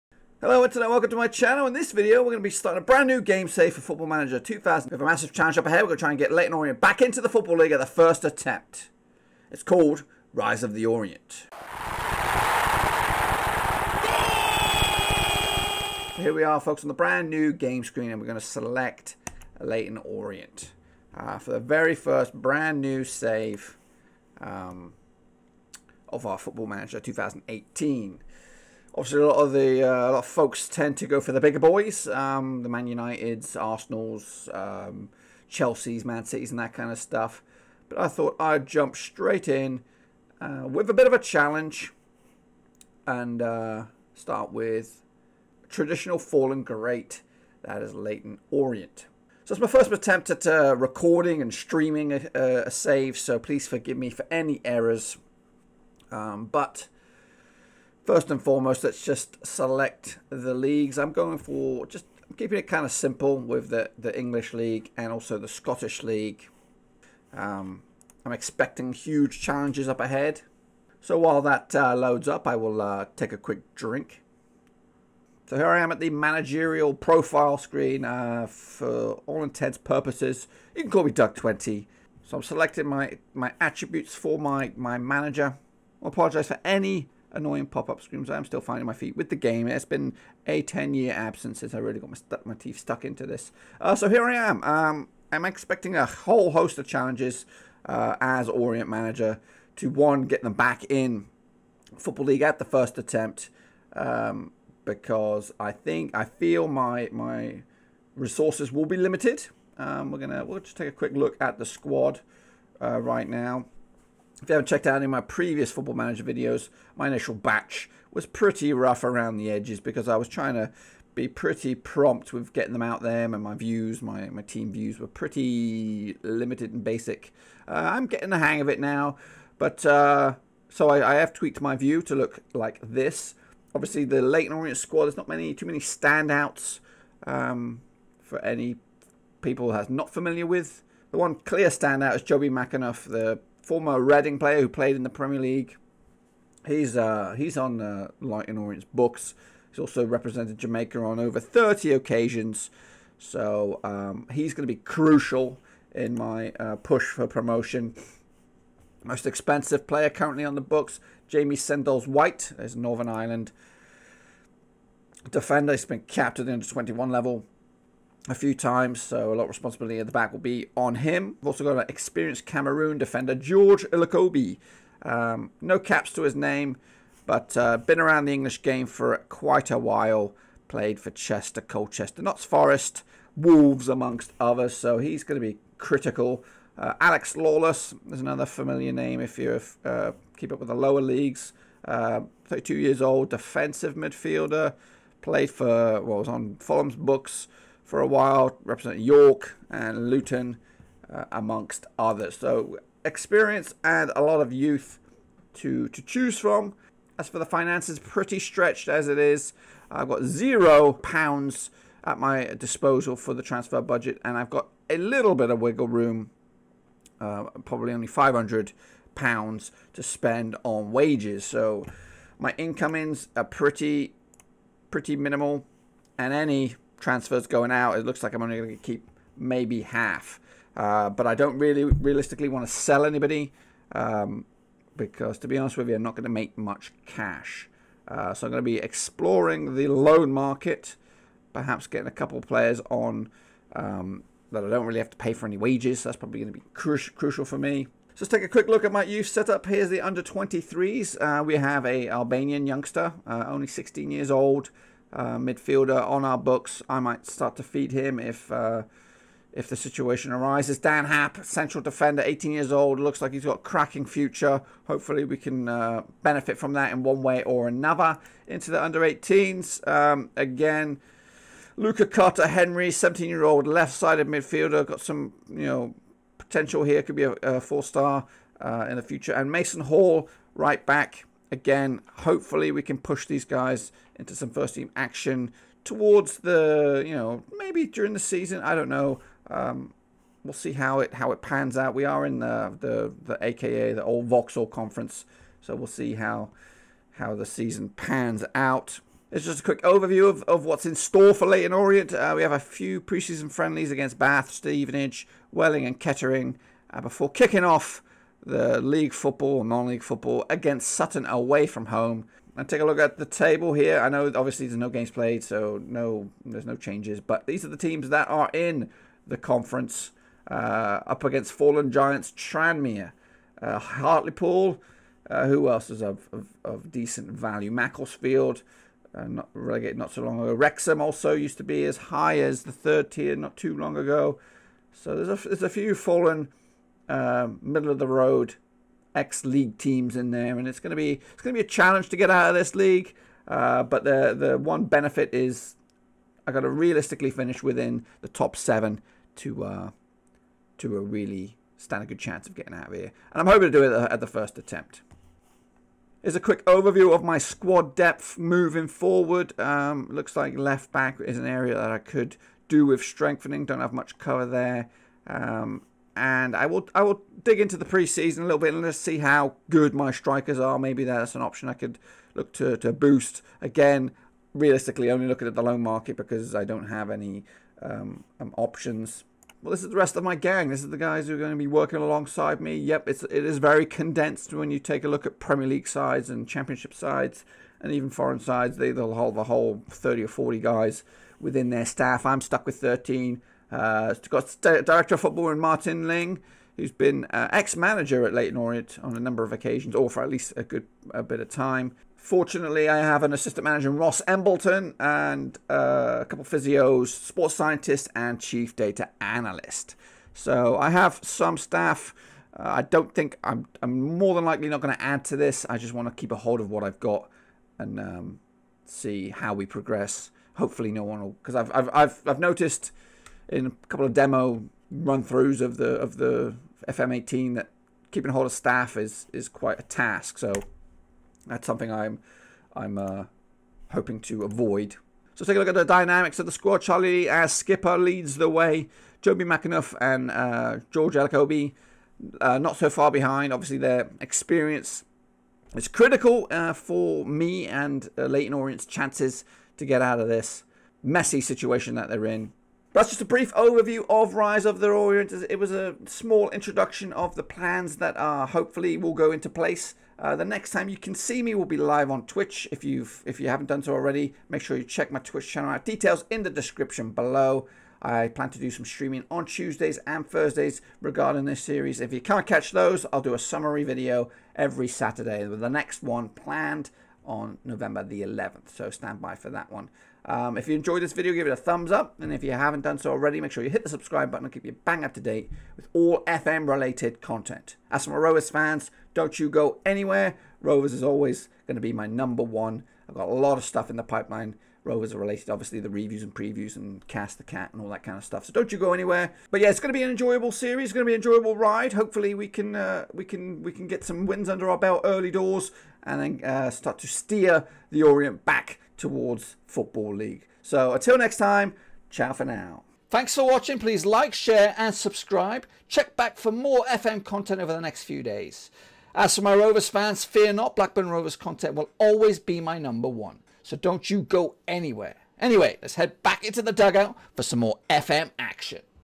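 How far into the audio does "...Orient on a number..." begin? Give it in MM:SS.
06:38.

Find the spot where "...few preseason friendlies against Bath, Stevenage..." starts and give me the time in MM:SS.
05:02.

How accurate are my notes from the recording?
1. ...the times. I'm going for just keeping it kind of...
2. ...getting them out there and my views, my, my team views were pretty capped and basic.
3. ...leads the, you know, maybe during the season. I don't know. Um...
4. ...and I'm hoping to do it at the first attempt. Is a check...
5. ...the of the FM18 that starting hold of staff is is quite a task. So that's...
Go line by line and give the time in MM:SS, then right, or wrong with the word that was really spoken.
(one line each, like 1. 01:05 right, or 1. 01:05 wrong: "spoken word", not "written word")
1. 01:00 wrong: "leagues", not "times"
2. 02:02 wrong: "limited", not "capped"
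3. 04:45 wrong: "towards", not "leads"
4. 05:53 wrong: "quick", not "check"
5. 07:05 wrong: "keeping", not "starting".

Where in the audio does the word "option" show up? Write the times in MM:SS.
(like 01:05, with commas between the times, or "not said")
06:11, 06:18.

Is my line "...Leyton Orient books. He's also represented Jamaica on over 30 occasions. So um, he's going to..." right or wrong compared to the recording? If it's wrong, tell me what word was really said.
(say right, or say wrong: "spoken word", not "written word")
right.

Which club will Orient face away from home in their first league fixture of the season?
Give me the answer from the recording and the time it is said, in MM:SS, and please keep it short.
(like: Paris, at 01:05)
Sutton, at 05:10.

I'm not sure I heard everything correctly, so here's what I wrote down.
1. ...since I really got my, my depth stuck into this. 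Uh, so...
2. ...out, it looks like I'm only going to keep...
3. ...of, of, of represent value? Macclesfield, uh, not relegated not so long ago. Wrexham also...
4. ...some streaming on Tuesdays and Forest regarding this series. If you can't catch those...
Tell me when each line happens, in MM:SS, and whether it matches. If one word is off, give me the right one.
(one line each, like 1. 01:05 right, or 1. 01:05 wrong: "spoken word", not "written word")
1. 01:31 wrong: "teeth", not "depth"
2. 03:47 right
3. 05:26 wrong: "decent", not "represent"
4. 07:48 wrong: "Thursdays", not "Forest".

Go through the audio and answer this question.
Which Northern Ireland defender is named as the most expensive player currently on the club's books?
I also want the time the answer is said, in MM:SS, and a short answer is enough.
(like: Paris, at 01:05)
Jamie Sendles-White, at 02:41.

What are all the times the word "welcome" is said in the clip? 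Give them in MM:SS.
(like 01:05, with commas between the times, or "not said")
00:00.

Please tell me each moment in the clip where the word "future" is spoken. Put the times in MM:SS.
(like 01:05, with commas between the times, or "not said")
04:24, 04:39.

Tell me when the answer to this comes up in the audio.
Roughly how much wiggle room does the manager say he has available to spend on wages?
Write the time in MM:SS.
03:38.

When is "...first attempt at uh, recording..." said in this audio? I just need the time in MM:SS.
00:49.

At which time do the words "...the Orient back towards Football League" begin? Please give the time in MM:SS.
08:27.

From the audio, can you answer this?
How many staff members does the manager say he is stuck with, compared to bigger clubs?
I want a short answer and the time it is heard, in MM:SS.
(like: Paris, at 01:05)
13, at 06:32.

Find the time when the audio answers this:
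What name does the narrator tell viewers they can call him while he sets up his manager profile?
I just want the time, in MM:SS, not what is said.
01:21.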